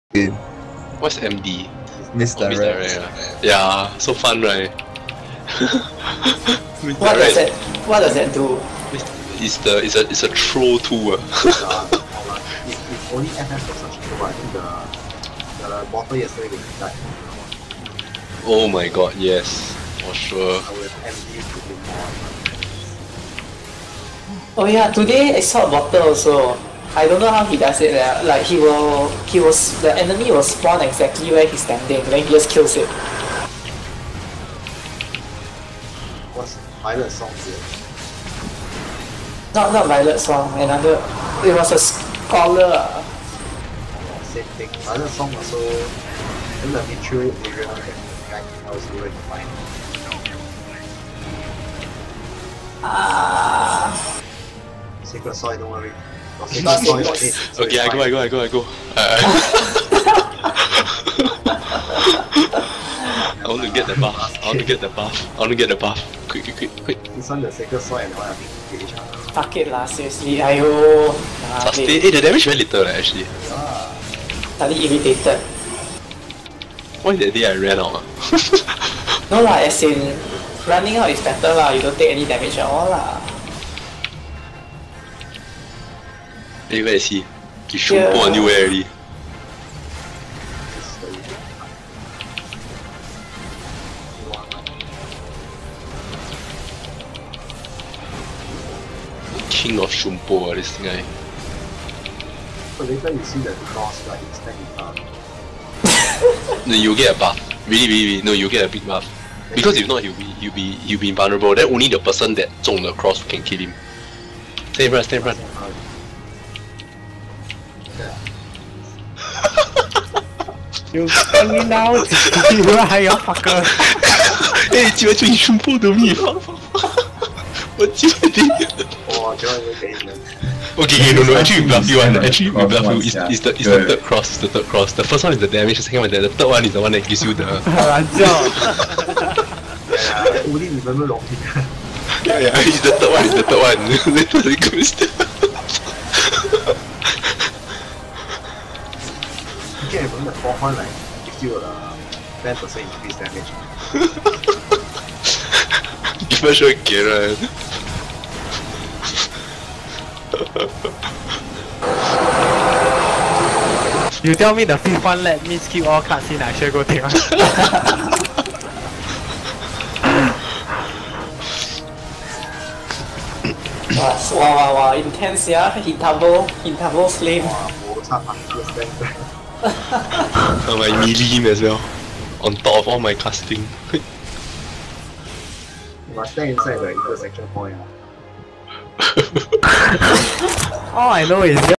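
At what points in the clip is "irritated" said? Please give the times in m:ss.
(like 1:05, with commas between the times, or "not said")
1:14.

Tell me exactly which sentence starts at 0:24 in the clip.
Oh yeah, today I saw a bottle also.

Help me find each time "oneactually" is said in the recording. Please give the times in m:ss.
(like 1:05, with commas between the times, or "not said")
2:11.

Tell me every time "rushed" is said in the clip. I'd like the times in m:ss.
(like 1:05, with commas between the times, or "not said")
not said.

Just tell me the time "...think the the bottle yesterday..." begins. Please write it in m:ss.
0:14.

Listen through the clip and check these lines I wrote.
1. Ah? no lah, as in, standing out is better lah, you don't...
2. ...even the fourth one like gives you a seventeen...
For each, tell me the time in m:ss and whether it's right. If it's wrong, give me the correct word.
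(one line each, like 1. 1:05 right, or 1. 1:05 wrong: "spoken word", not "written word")
1. 1:18 wrong: "running", not "standing"
2. 2:30 wrong: "ten", not "seventeen".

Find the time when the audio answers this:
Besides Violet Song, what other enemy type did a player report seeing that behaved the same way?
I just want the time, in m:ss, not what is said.
0:41.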